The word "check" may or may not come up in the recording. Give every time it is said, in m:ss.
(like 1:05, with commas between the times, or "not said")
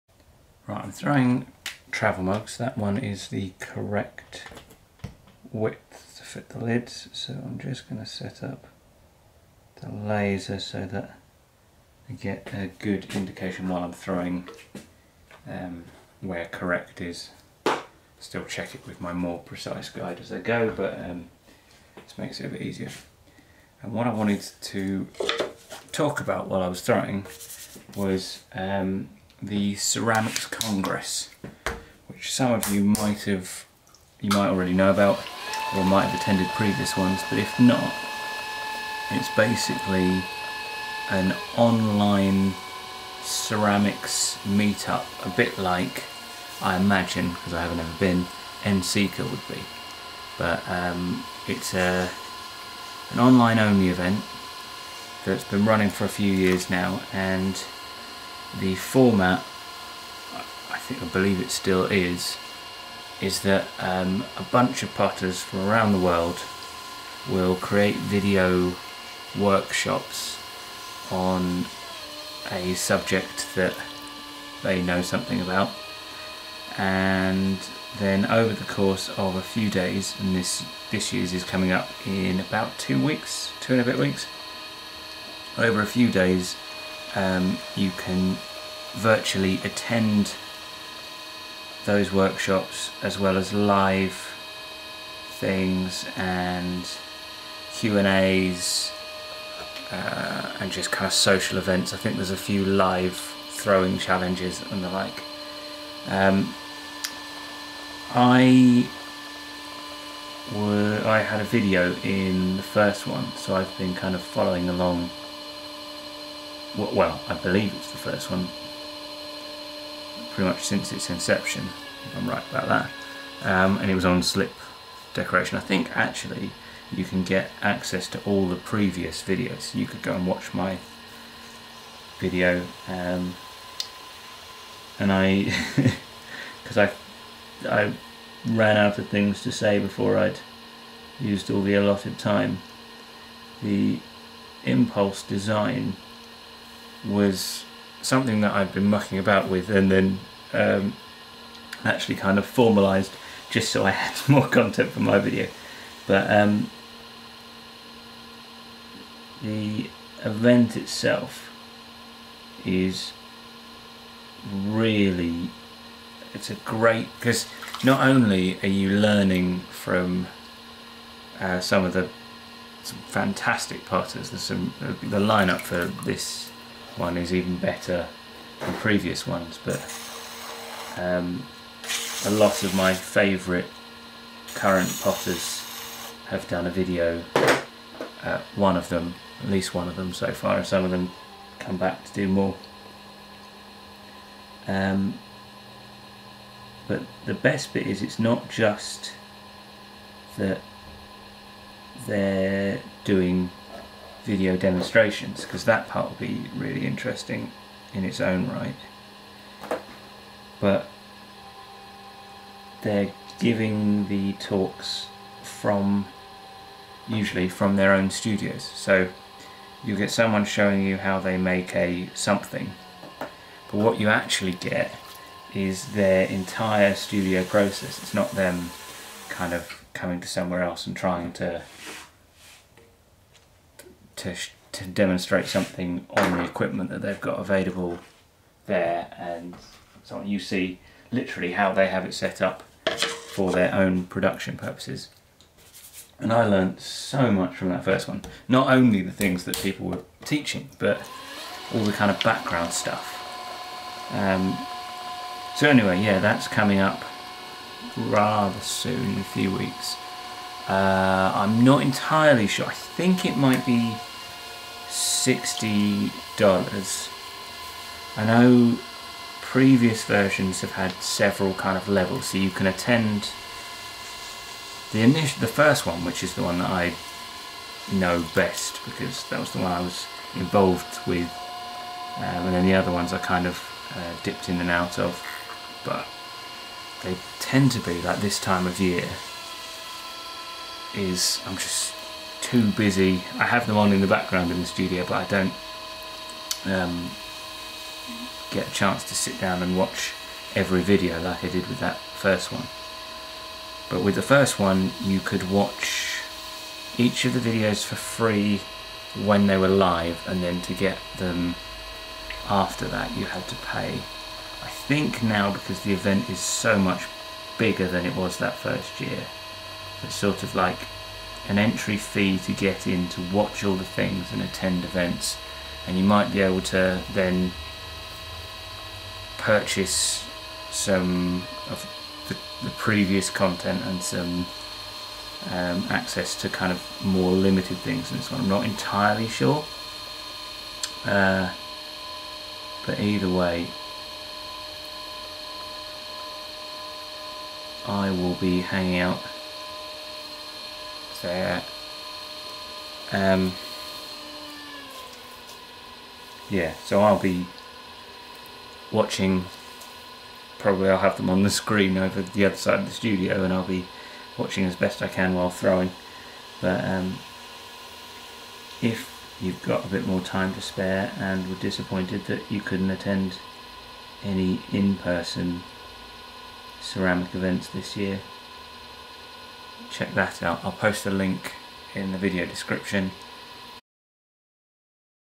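0:18, 6:19.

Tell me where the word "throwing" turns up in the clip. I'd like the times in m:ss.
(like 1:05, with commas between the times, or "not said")
0:00, 0:13, 0:26, 1:43, 6:05.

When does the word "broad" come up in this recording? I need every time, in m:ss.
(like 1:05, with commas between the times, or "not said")
not said.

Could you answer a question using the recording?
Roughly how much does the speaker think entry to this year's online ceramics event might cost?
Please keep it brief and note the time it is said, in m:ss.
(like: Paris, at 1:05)
$60, at 4:24.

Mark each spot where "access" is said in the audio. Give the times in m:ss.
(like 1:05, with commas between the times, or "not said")
2:07, 5:35.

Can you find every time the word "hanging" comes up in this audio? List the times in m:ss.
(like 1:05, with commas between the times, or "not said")
5:48.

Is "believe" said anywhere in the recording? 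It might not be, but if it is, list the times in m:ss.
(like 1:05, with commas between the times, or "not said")
1:01, 1:57.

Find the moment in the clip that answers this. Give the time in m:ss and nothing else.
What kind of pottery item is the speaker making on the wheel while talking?
0:01.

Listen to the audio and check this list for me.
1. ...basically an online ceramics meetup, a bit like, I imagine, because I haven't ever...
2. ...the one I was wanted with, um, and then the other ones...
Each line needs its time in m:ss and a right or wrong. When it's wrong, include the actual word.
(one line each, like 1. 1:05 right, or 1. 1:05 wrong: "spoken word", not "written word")
1. 0:39 right
2. 4:39 wrong: "involved", not "wanted".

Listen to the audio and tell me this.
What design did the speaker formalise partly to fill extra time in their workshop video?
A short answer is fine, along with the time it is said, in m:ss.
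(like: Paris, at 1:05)
Impulse design, at 2:24.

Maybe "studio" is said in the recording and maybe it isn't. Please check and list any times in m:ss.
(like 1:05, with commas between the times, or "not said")
3:38, 3:46, 4:54, 6:02.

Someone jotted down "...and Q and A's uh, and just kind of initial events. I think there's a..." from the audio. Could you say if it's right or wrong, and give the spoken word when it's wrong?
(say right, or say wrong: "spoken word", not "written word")
wrong: "social", not "initial".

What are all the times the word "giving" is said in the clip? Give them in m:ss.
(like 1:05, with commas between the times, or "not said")
3:33.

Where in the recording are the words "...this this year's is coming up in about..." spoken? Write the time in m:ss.
1:20.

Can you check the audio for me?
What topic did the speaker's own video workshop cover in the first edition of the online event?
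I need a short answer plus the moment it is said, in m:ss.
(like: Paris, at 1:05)
Slip decoration, at 2:04.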